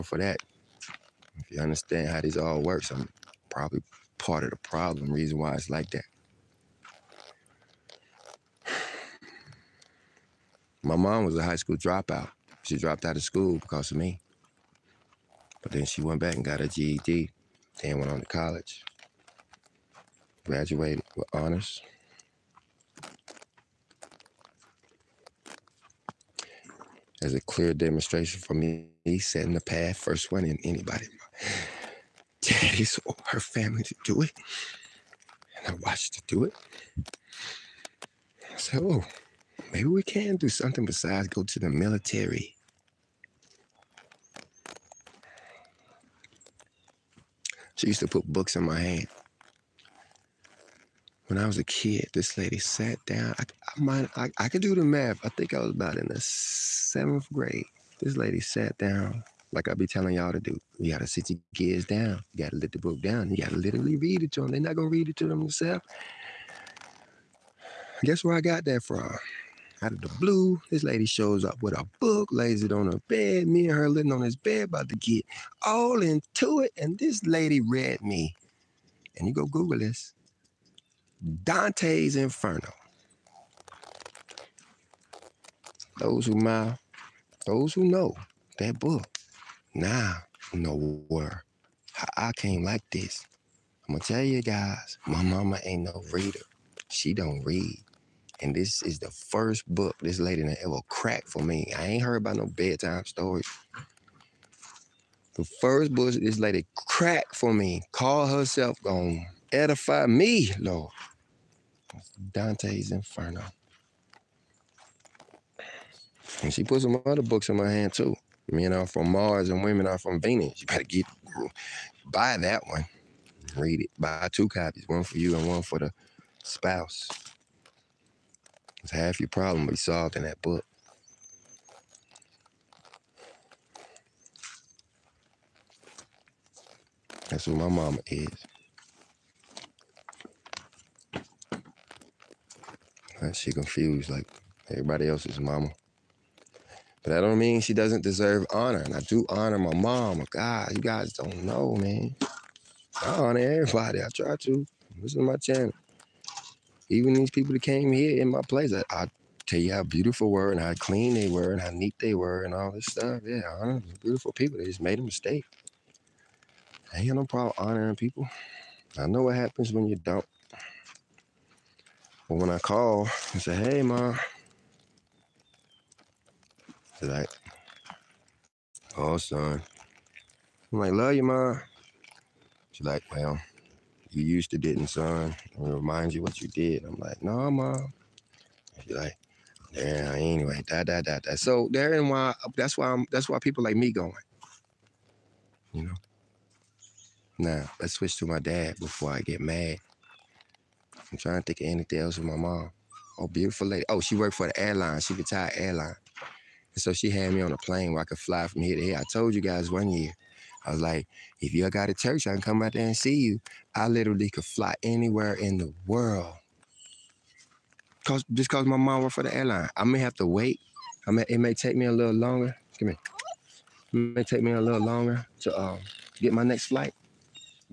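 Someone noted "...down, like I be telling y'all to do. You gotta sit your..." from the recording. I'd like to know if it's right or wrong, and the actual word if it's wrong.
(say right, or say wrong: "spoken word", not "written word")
right.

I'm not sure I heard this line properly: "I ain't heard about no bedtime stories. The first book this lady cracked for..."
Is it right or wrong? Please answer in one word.
right.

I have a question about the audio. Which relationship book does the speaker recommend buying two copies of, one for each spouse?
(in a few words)
Men are from Mars and women are from Venus.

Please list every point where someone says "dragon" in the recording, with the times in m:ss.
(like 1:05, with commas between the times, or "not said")
not said.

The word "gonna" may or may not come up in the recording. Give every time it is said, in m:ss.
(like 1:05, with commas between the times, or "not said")
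1:04, 1:33, 1:48.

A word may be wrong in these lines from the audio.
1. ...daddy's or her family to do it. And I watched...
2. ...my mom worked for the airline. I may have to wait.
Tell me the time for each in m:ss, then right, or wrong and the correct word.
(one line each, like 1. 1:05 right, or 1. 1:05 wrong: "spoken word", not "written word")
1. 0:32 right
2. 3:38 right.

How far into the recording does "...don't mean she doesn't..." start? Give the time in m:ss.
2:27.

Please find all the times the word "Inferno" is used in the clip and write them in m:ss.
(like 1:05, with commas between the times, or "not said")
1:22, 1:52.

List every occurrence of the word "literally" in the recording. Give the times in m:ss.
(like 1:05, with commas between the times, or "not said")
1:03, 3:33.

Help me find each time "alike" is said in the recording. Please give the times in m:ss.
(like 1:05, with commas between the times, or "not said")
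not said.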